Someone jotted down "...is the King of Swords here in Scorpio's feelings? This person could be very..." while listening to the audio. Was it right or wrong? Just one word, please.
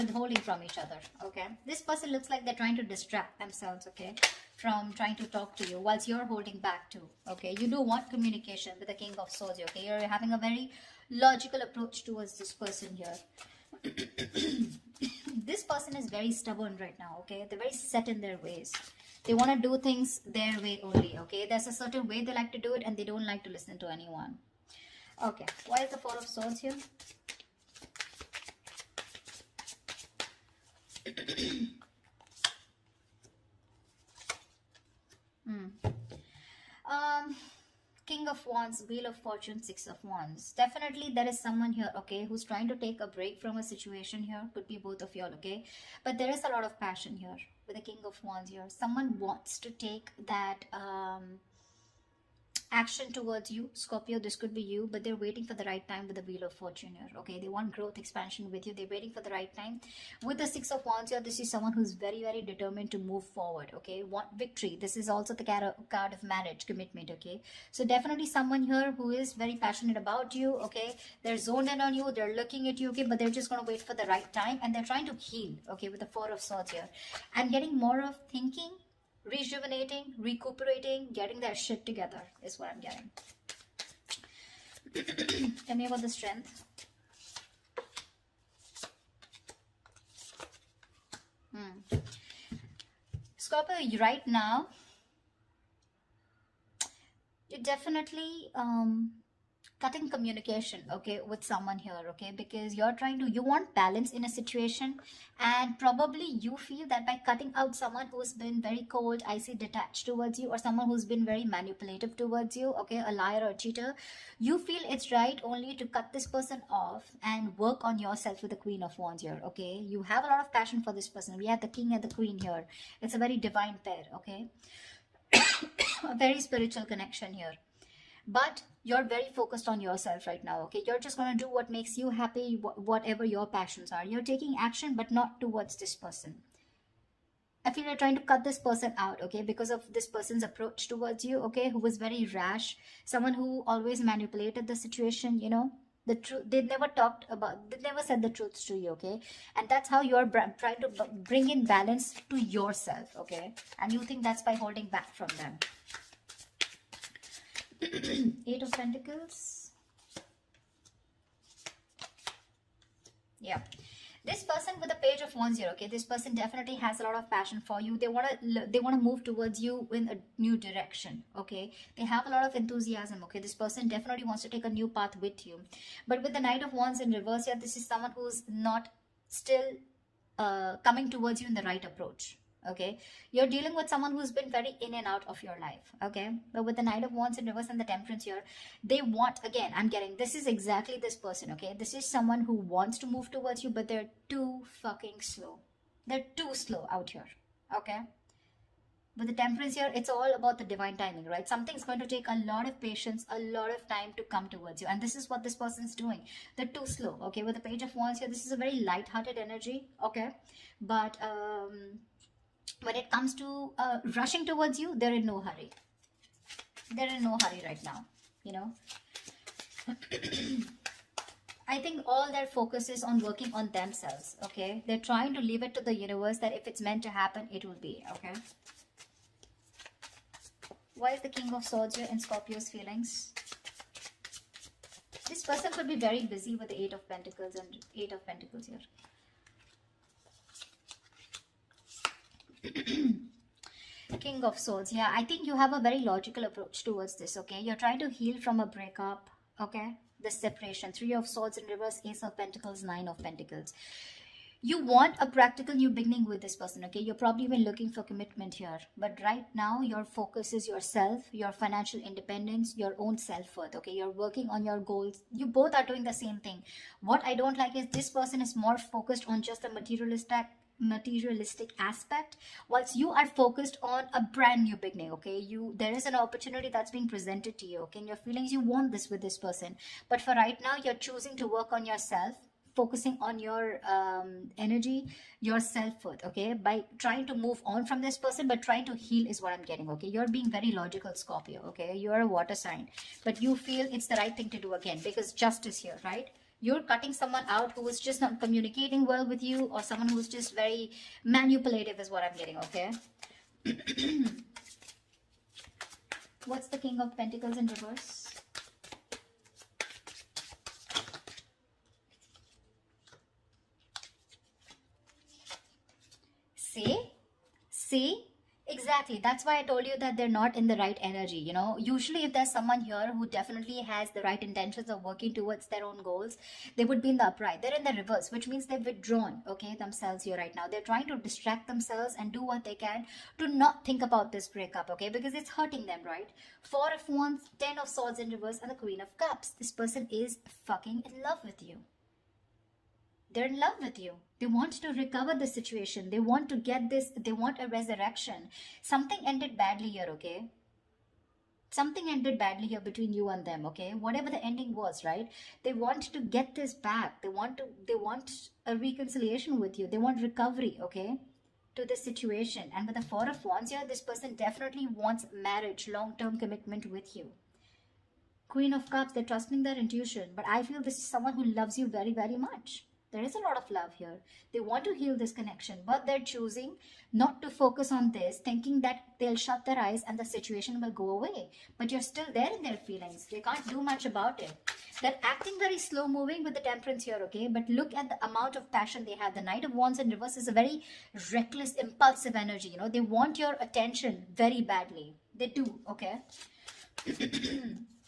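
right.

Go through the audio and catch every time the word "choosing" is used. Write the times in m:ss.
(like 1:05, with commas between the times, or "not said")
4:41, 6:16.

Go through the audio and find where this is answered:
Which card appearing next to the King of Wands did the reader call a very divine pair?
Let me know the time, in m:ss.
1:58.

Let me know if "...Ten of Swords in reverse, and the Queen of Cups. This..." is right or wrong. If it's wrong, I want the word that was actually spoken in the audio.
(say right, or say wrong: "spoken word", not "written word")
right.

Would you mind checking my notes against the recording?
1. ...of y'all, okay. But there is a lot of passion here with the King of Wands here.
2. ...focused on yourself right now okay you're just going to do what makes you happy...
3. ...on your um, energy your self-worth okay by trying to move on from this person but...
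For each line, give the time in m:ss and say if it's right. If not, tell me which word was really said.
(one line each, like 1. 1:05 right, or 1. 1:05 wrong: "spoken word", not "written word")
1. 0:45 right
2. 2:09 right
3. 4:43 right.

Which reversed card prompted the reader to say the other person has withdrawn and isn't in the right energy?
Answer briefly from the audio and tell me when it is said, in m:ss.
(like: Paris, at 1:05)
King of Pentacles, at 5:06.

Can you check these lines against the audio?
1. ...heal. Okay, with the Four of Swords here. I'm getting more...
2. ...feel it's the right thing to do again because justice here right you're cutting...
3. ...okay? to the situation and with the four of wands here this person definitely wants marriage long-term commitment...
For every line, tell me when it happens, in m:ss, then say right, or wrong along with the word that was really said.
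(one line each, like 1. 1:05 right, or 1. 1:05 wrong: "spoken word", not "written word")
1. 1:15 right
2. 4:53 right
3. 6:00 right.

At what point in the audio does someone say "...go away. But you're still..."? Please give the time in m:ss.
6:20.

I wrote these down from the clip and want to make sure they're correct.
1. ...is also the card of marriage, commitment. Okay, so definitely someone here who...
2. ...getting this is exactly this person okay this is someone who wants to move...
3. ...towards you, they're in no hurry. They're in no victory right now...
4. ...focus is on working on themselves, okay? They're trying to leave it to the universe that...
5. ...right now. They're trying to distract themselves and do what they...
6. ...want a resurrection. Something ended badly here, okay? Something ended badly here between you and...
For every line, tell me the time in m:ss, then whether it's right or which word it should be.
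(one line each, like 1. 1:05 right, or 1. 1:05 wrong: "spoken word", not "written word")
1. 1:04 right
2. 3:09 right
3. 3:34 wrong: "hurry", not "victory"
4. 3:42 right
5. 5:30 right
6. 5:47 right.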